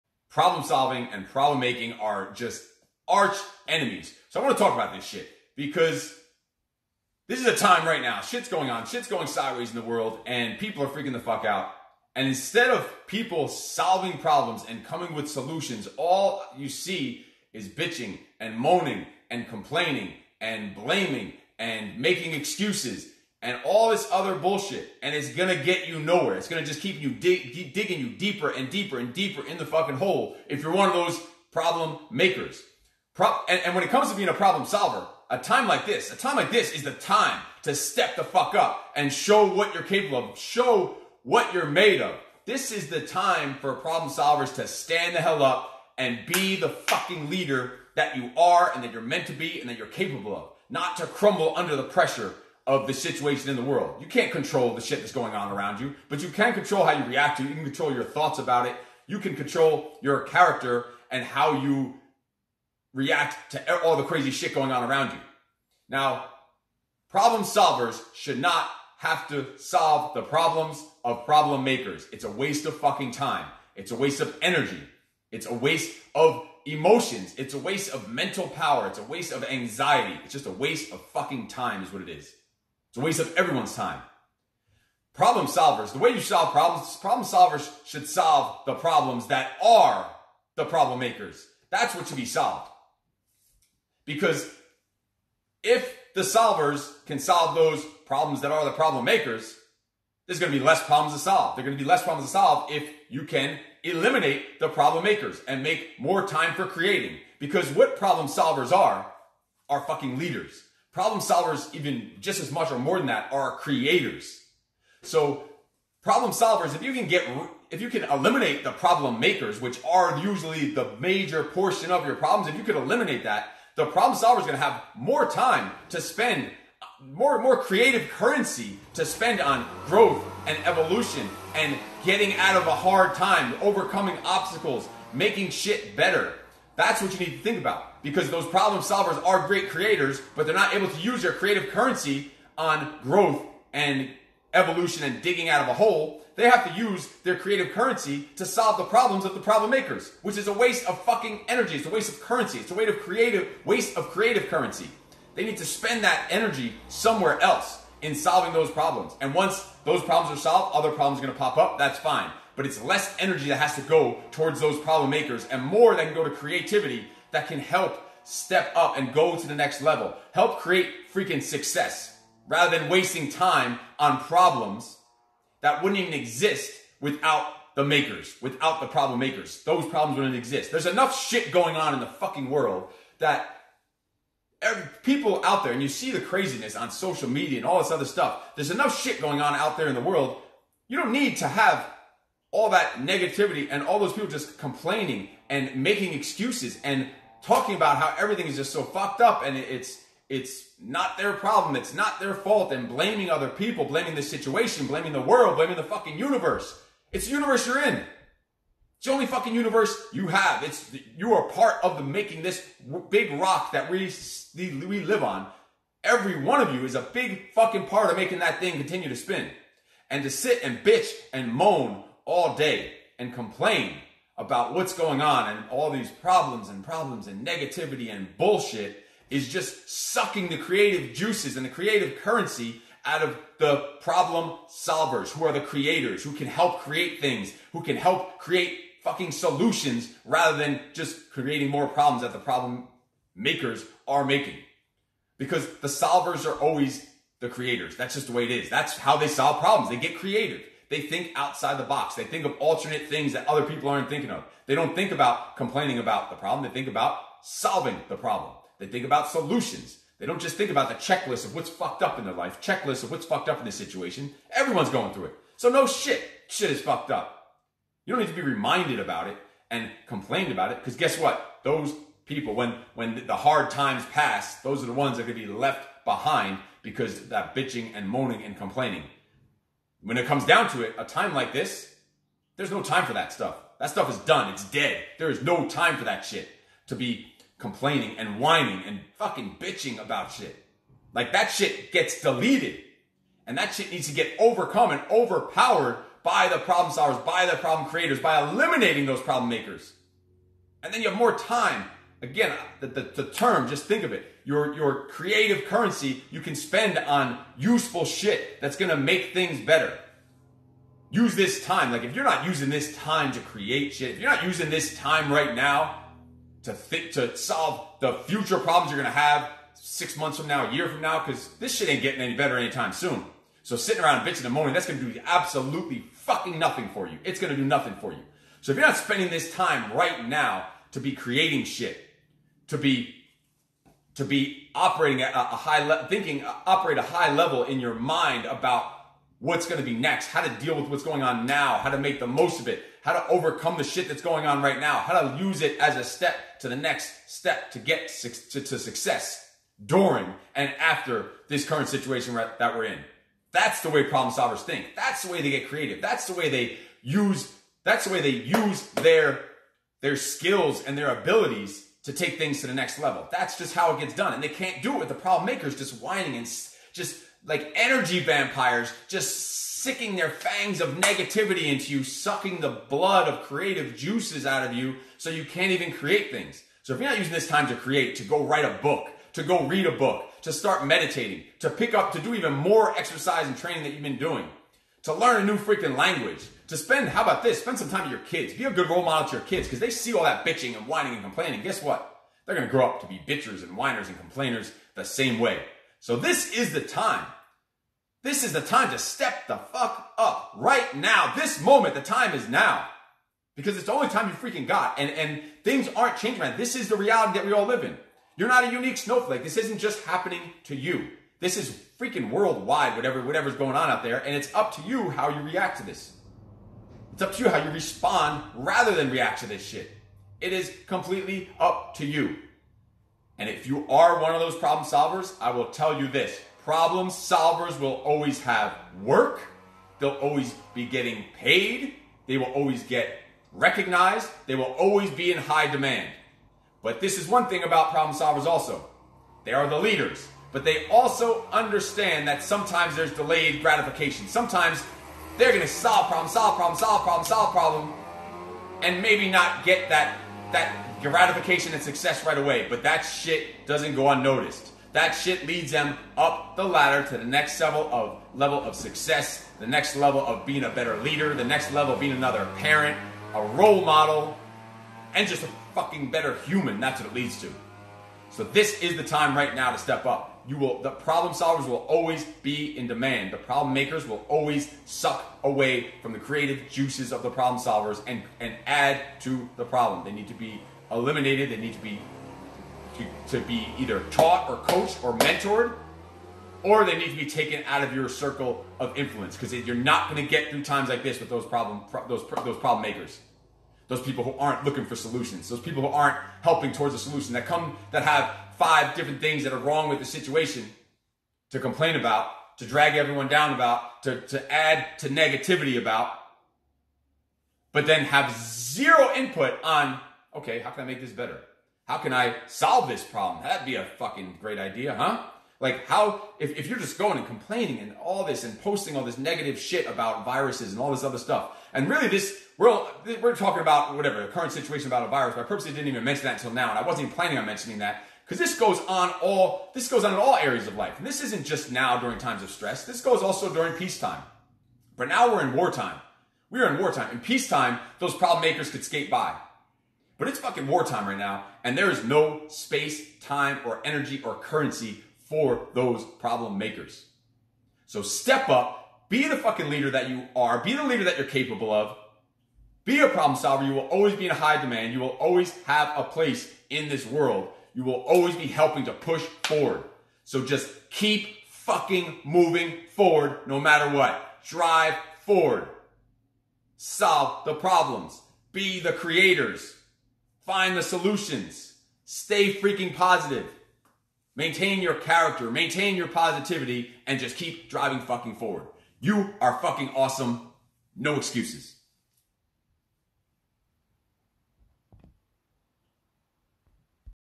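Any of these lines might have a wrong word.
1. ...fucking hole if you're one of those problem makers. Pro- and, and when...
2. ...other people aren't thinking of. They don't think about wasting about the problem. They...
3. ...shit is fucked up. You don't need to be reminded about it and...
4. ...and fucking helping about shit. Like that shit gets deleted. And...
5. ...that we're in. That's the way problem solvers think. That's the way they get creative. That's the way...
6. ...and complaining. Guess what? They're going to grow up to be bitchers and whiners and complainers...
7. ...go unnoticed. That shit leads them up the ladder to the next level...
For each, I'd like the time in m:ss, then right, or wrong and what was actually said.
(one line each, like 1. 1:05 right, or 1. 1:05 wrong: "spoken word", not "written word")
1. 0:29 right
2. 4:13 wrong: "complaining", not "wasting"
3. 4:26 right
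4. 4:48 wrong: "bitching", not "helping"
5. 5:52 right
6. 6:31 right
7. 7:33 right.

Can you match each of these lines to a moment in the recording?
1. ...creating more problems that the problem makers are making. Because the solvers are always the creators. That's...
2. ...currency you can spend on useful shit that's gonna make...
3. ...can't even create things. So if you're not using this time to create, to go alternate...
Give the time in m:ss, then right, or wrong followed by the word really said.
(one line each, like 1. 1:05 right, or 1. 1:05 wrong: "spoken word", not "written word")
1. 4:01 right
2. 5:05 right
3. 6:15 wrong: "write", not "alternate".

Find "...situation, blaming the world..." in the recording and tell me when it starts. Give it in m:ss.
3:24.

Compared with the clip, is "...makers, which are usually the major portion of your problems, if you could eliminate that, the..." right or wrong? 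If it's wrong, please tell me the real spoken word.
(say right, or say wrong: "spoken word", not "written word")
right.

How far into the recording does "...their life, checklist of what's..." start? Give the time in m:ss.
4:22.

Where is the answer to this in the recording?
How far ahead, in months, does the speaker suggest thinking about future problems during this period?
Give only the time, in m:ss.
5:19.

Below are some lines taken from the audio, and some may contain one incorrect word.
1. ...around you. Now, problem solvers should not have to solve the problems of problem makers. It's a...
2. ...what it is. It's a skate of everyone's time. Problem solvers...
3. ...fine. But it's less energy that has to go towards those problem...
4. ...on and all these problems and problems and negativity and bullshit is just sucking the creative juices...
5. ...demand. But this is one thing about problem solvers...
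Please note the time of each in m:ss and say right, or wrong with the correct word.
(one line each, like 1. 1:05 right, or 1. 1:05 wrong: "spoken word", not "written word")
1. 1:04 right
2. 1:21 wrong: "waste", not "skate"
3. 2:41 right
4. 3:45 right
5. 7:15 right.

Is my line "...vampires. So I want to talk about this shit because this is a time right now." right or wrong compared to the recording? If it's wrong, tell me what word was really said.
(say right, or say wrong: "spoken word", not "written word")
wrong: "enemies", not "vampires".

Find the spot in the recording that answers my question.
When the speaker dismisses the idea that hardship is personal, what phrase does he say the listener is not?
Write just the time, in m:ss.
6:48.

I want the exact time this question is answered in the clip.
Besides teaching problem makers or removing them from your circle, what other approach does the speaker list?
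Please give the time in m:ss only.
8:04.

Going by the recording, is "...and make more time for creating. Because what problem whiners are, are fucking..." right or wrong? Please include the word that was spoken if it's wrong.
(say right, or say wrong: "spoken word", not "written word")
wrong: "solvers", not "whiners".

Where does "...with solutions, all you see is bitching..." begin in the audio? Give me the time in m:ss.
0:15.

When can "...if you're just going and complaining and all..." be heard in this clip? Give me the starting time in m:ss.
8:36.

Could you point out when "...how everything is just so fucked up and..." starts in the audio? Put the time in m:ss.
3:17.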